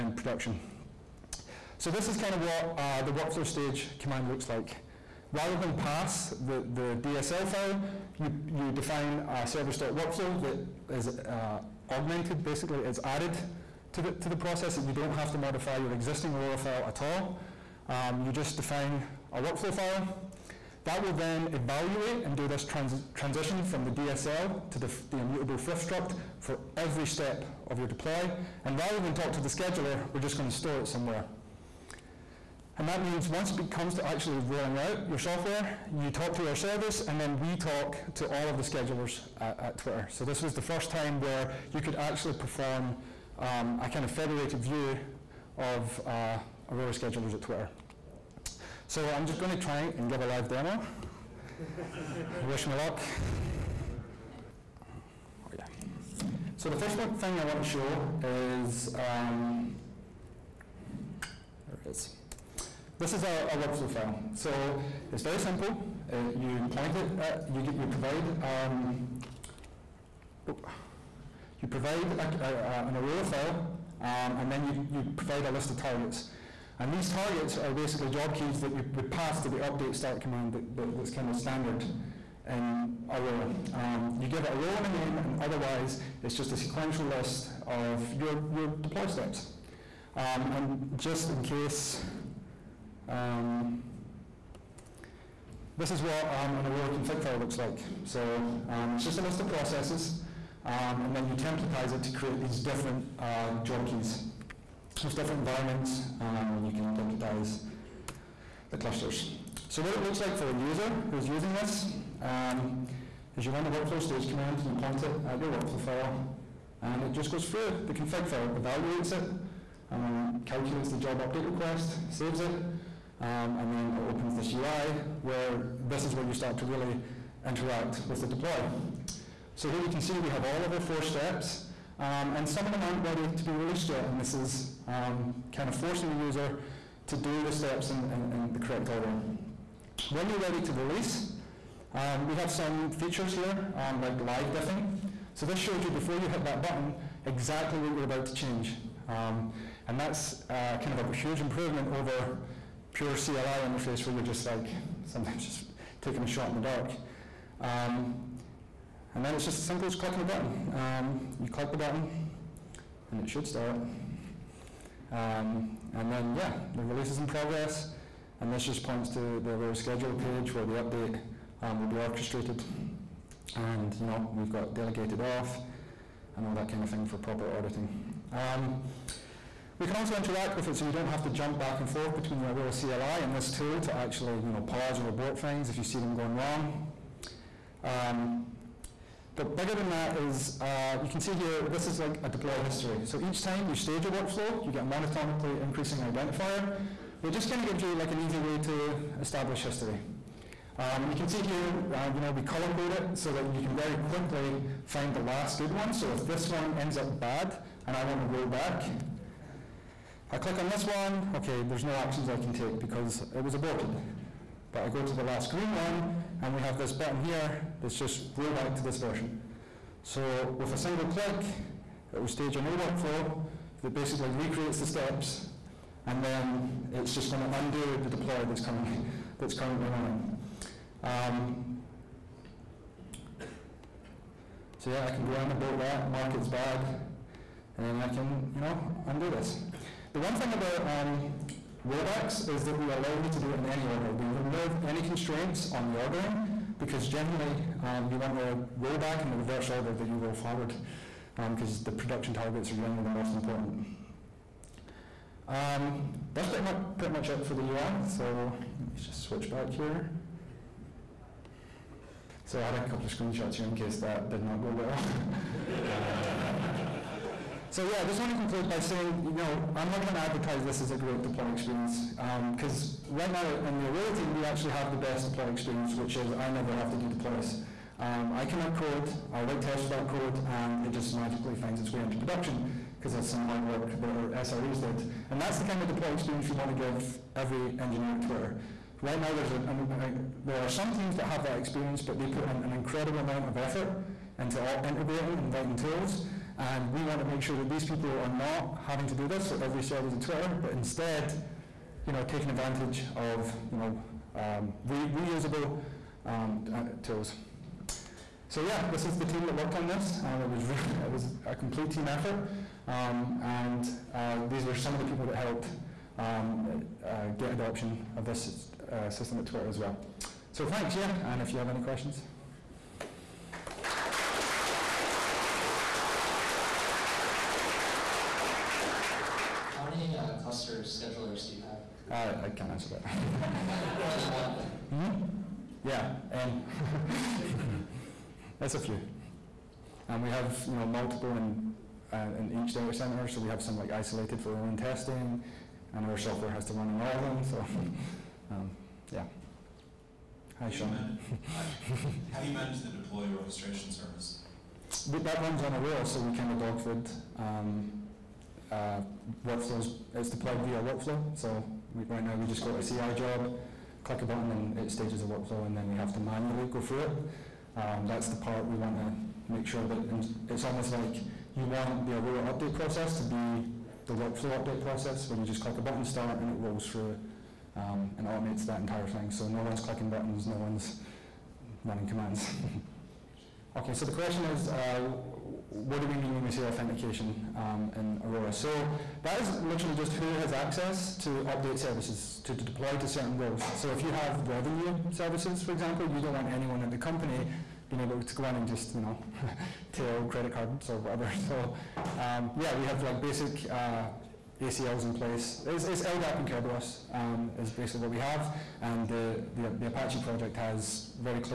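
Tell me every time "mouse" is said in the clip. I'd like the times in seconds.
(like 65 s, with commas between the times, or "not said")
not said.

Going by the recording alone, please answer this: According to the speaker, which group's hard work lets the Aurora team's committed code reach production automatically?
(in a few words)
SREs.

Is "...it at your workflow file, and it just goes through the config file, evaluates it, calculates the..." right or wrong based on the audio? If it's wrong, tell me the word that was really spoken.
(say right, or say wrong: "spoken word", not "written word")
right.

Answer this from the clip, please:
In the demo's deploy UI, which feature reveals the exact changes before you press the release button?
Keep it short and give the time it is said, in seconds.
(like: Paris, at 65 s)
Live diffing, at 144 s.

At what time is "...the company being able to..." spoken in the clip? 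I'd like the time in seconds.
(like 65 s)
396 s.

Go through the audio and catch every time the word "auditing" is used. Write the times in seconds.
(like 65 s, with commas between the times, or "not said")
177 s.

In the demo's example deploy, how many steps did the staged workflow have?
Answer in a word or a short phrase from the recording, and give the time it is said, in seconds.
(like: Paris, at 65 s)
4, at 130 s.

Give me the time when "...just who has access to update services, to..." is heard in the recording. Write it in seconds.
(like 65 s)
389 s.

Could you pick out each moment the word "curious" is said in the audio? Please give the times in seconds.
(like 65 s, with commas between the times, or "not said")
not said.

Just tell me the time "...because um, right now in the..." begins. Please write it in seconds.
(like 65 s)
272 s.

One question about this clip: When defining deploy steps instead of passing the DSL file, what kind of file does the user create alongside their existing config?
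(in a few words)
service.workflow.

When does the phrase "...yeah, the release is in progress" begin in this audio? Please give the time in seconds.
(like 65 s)
166 s.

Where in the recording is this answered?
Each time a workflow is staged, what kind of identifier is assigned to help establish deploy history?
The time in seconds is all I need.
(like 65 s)
194 s.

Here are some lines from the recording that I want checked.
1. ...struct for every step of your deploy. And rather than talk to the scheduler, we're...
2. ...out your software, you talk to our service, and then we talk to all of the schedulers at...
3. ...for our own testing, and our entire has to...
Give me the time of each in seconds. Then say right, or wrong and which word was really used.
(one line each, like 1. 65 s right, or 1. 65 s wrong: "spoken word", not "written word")
1. 25 s right
2. 34 s right
3. 344 s wrong: "software", not "entire".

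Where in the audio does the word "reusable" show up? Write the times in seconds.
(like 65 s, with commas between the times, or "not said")
305 s.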